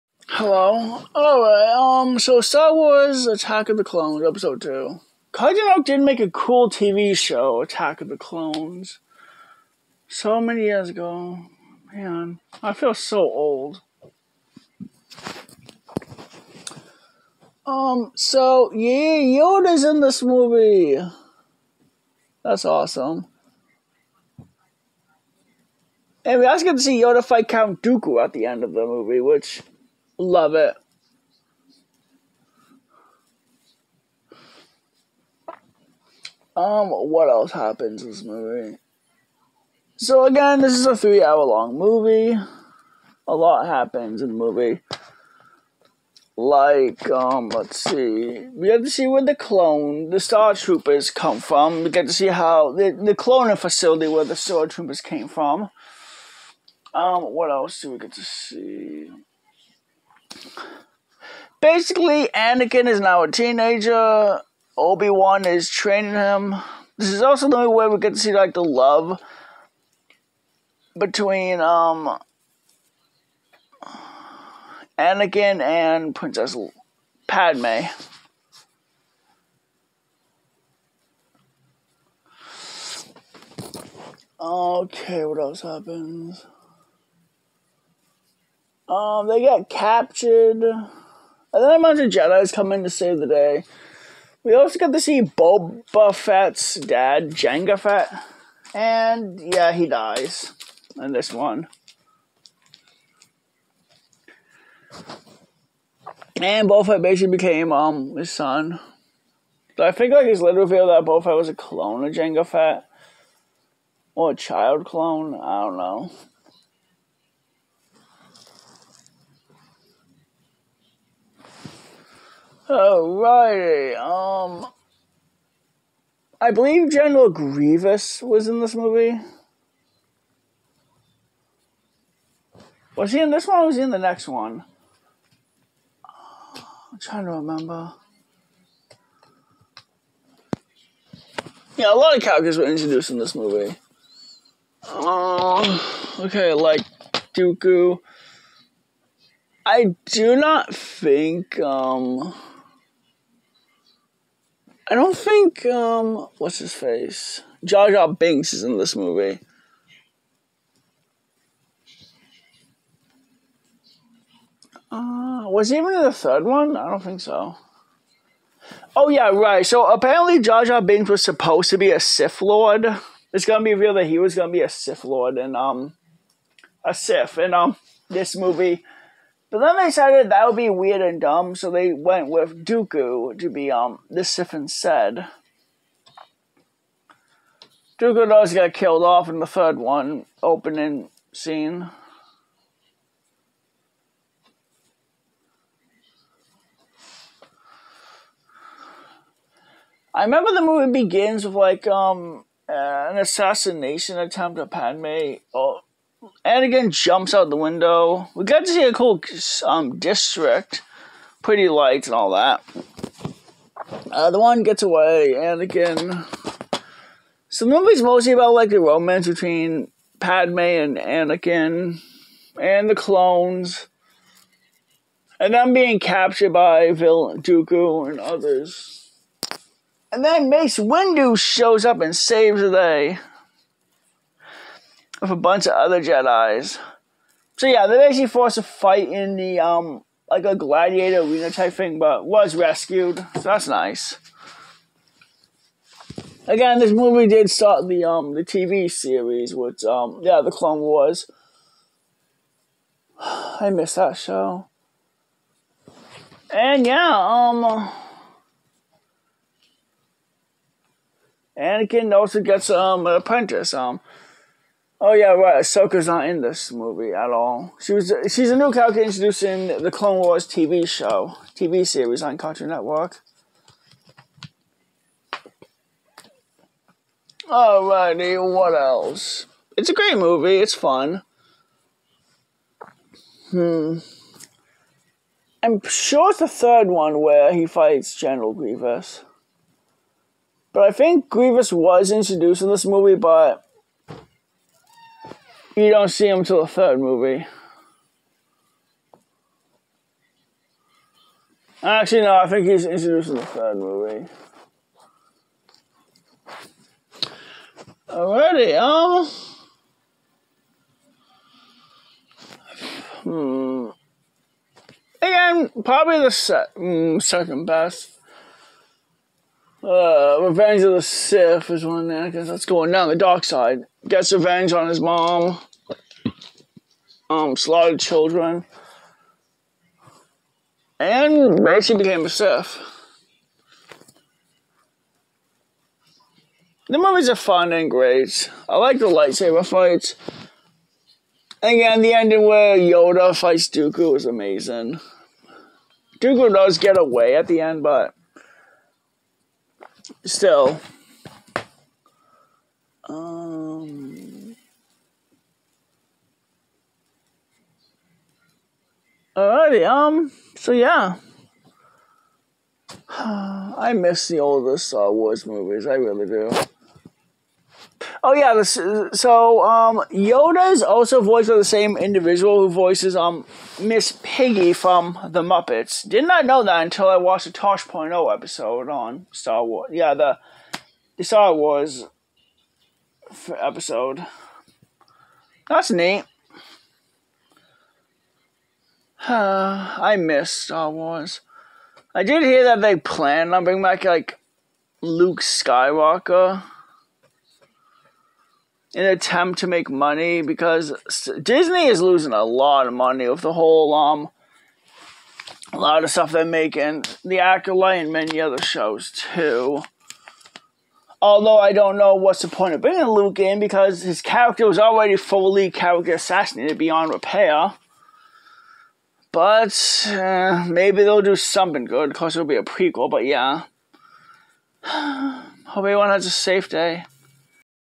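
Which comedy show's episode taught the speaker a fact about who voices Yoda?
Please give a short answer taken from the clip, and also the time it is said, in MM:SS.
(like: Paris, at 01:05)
Tosh.0, at 06:17.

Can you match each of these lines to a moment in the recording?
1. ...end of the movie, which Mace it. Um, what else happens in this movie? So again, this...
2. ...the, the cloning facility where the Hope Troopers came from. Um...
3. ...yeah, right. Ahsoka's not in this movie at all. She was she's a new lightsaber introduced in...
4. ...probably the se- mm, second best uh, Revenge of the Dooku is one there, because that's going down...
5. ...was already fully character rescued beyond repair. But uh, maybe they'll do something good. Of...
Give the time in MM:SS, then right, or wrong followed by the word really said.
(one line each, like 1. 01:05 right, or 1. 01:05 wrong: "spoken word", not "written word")
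1. 00:28 wrong: "Love", not "Mace"
2. 00:52 wrong: "Star", not "Hope"
3. 04:25 wrong: "character", not "lightsaber"
4. 05:15 wrong: "Sith", not "Dooku"
5. 06:54 wrong: "assassinated", not "rescued".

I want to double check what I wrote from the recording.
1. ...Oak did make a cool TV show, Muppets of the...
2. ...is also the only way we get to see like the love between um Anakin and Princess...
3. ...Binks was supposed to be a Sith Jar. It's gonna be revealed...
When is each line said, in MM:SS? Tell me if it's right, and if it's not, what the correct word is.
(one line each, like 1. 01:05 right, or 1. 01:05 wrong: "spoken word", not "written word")
1. 00:05 wrong: "Attack", not "Muppets"
2. 01:07 right
3. 02:50 wrong: "Lord", not "Jar".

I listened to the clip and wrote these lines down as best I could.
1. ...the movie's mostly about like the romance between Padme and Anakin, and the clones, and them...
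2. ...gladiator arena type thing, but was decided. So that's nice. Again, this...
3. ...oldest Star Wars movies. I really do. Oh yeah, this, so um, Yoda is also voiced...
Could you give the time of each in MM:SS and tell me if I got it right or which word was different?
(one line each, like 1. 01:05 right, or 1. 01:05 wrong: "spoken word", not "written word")
1. 03:37 right
2. 04:00 wrong: "rescued", not "decided"
3. 06:04 right.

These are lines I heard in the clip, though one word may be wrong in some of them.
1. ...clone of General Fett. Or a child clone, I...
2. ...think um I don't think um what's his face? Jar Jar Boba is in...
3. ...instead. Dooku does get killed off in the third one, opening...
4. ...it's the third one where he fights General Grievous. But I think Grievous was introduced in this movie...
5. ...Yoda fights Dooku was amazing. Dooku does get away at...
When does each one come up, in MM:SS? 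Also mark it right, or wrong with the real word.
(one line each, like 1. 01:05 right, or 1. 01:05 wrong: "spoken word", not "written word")
1. 01:51 wrong: "Jango", not "General"
2. 02:30 wrong: "Binks", not "Boba"
3. 03:04 right
4. 04:46 right
5. 05:42 right.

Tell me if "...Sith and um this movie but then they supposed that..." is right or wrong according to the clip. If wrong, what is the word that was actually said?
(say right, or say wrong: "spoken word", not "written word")
wrong: "decided", not "supposed".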